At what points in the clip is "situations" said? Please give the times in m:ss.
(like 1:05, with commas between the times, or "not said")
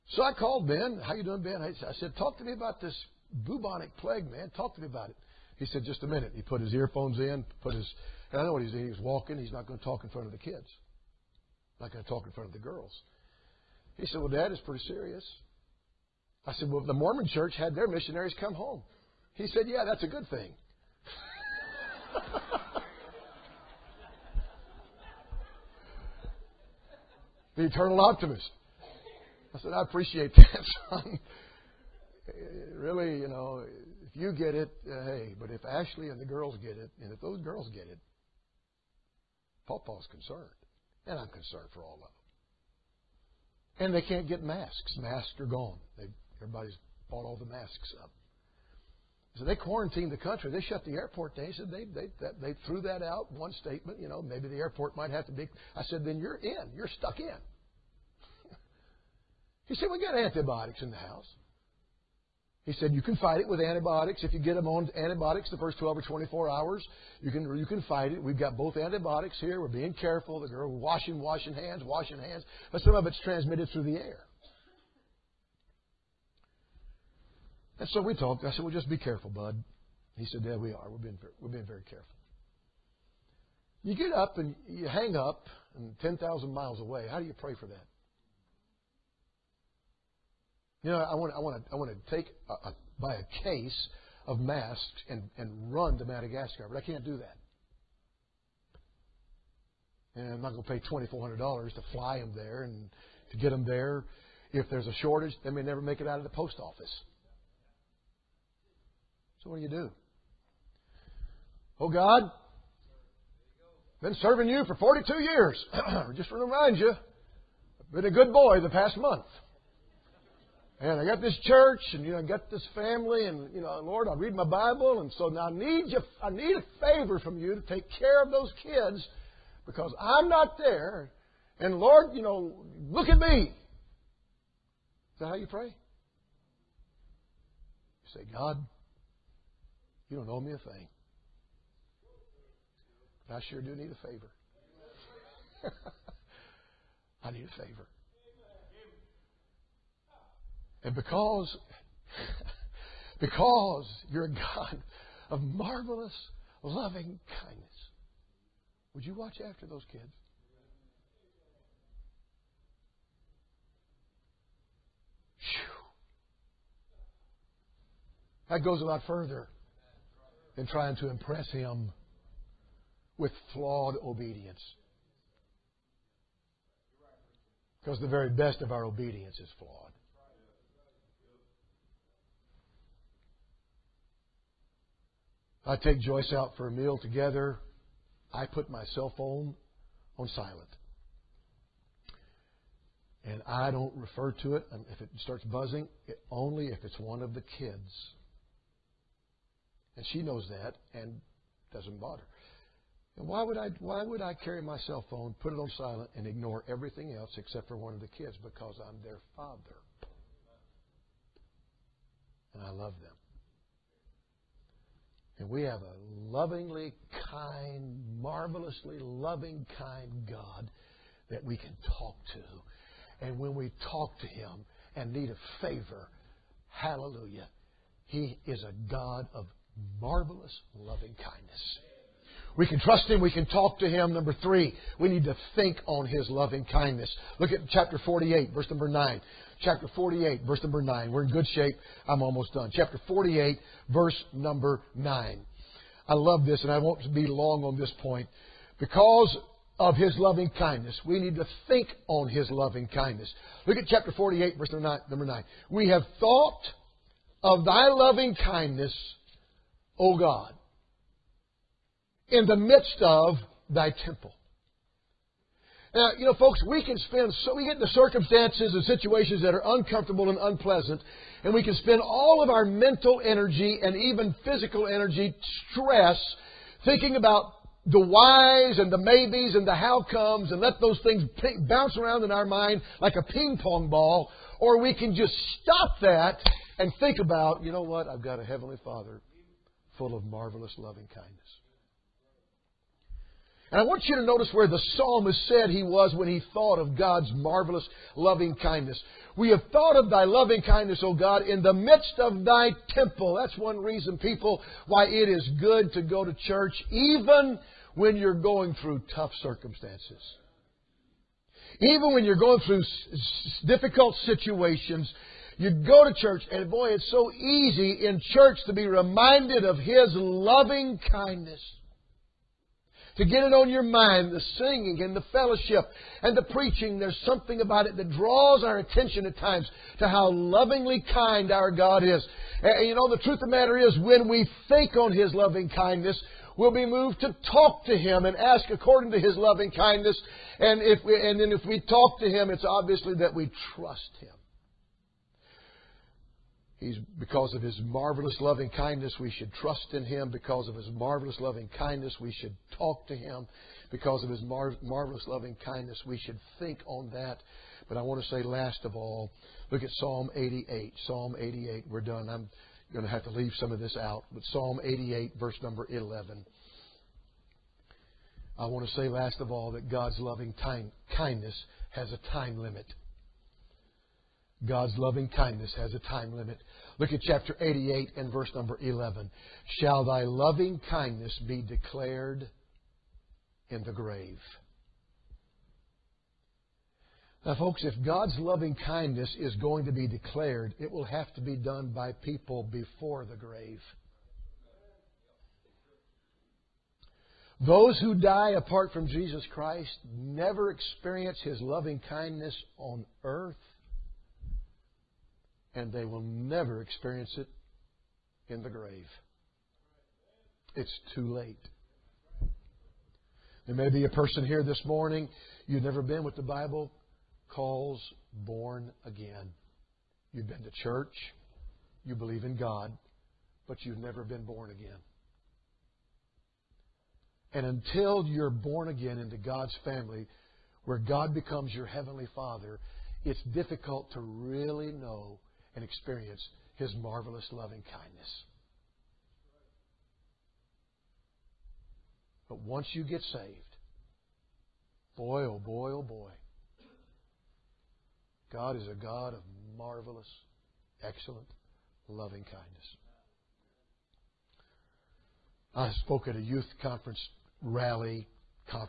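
4:28, 5:14.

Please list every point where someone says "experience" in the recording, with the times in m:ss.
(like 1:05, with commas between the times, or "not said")
6:40, 6:46, 7:15.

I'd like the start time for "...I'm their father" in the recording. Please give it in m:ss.
3:28.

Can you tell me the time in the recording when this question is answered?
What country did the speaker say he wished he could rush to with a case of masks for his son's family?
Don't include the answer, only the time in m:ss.
1:36.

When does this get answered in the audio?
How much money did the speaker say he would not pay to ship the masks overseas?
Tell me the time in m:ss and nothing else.
1:40.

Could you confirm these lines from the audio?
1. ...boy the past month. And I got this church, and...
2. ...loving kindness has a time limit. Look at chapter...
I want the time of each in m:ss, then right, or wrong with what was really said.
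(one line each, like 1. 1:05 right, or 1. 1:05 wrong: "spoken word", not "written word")
1. 1:58 right
2. 6:14 right.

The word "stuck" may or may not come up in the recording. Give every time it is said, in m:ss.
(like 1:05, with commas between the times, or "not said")
0:56.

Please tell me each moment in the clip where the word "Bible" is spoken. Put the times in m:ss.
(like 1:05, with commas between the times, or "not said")
2:04, 6:56.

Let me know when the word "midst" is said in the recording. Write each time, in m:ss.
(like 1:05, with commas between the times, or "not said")
4:22, 5:01.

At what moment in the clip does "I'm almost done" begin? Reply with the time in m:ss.
4:02.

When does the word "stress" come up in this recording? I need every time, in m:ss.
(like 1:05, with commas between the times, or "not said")
4:35.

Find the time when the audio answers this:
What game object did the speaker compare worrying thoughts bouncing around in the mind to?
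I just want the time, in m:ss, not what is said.
4:43.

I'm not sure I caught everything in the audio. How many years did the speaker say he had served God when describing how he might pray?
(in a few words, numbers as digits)
42.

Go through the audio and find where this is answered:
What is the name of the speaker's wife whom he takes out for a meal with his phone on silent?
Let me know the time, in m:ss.
3:05.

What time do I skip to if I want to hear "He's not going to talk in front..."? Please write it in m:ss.
0:09.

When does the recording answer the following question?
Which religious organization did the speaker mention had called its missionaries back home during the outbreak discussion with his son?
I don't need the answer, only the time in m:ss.
0:16.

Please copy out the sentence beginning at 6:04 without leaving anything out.
But Psalm 88, verse number 11.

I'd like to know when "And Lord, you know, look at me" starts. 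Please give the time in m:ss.
2:11.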